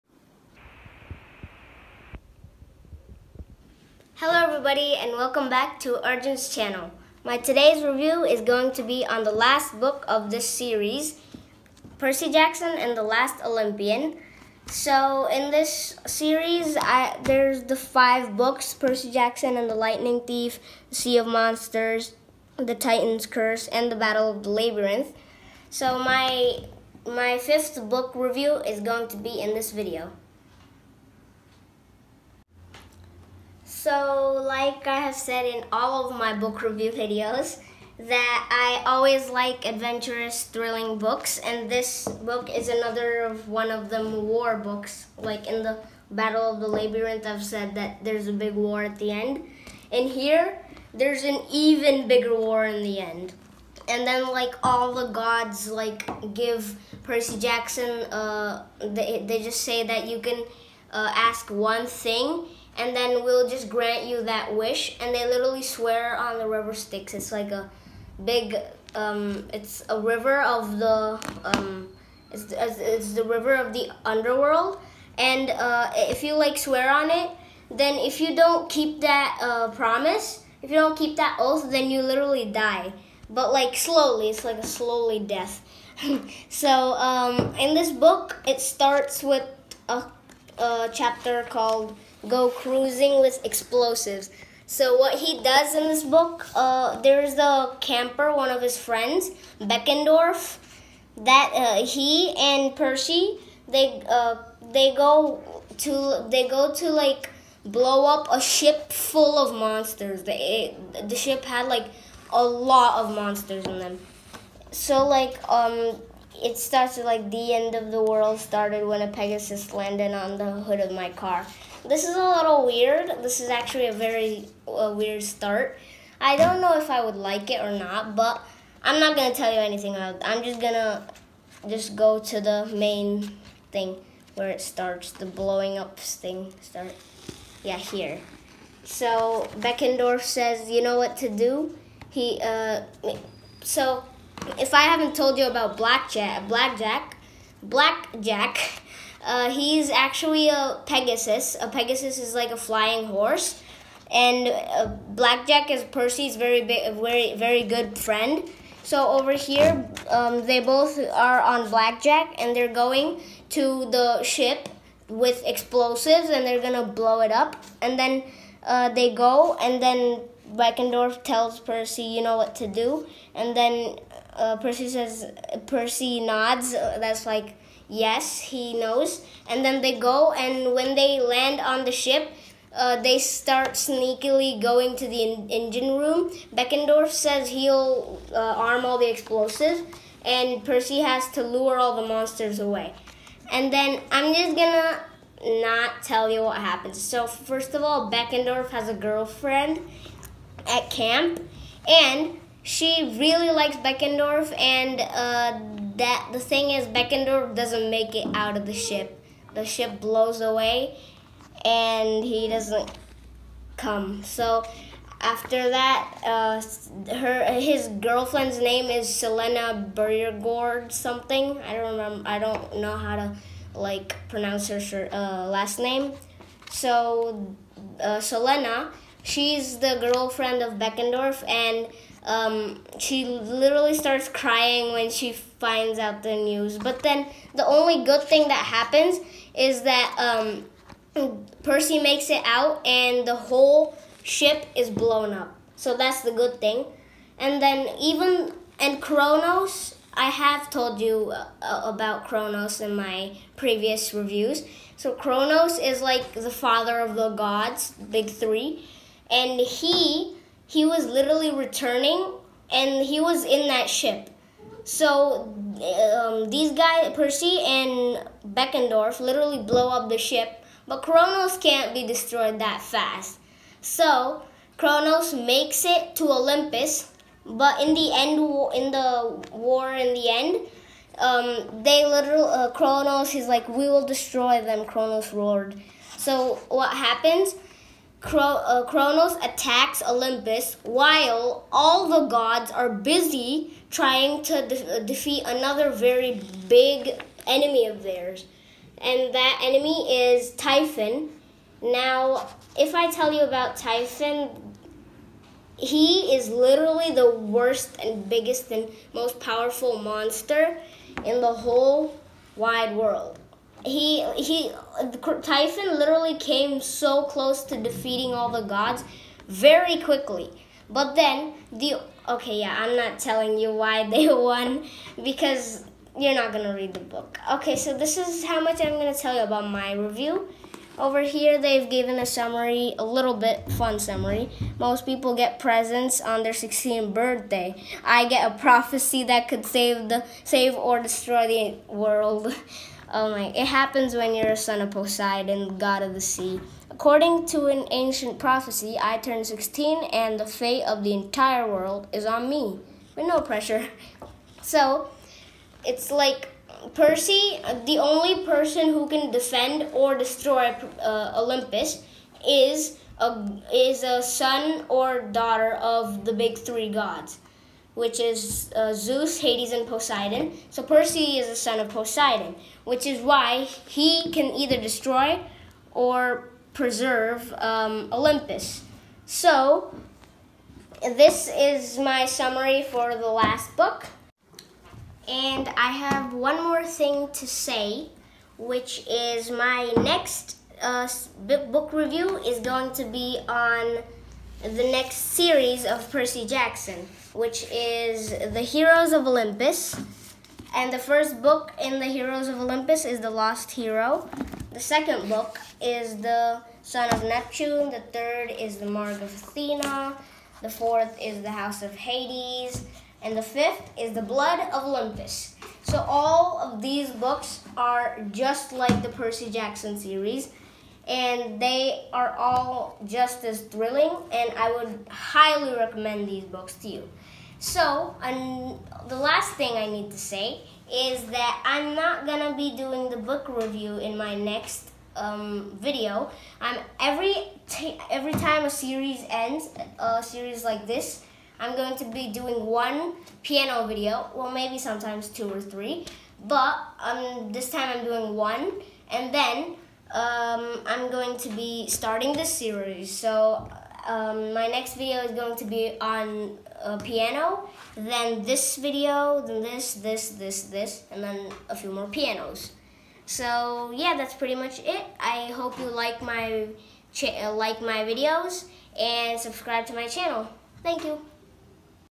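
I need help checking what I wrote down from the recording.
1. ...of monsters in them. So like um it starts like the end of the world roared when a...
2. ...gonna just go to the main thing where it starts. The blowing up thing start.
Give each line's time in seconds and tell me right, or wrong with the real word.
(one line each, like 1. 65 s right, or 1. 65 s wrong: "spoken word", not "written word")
1. 113 s wrong: "started", not "roared"
2. 130 s right.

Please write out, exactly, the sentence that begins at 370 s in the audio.
So Percy is a son of Poseidon, which is why he can either destroy or preserve um, Olympus.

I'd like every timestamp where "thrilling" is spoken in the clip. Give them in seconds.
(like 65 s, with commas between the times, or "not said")
40 s, 423 s.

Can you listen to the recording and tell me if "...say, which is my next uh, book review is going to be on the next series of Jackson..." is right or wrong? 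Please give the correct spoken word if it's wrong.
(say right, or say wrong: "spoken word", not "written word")
wrong: "Percy", not "Jackson".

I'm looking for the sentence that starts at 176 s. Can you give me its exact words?
Uh, that's like, yes, he knows.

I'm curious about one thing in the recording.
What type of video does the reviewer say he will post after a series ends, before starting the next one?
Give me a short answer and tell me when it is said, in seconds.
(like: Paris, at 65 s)
piano video, at 443 s.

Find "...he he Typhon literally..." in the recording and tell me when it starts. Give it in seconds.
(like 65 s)
313 s.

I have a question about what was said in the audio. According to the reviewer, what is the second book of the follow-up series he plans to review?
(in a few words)
The Son of Neptune.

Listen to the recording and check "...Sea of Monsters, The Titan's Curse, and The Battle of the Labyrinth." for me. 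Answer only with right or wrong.
right.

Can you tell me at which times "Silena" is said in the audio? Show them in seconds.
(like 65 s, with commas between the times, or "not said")
219 s, 228 s.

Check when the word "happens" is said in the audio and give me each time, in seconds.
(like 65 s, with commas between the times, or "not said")
196 s, 238 s, 286 s, 343 s.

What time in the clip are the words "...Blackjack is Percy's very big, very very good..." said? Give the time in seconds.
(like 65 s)
155 s.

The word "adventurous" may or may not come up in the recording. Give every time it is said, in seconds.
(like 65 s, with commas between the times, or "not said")
39 s.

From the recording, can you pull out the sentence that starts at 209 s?
The ship blows away, and he doesn't come.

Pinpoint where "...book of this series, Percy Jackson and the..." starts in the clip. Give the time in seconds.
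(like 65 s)
9 s.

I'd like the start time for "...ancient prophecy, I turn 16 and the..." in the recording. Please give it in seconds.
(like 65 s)
347 s.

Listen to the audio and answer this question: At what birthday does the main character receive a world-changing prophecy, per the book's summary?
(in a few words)
16th.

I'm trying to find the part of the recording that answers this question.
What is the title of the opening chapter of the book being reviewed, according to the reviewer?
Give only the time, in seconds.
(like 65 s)
92 s.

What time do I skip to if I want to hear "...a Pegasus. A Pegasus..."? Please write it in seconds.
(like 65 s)
150 s.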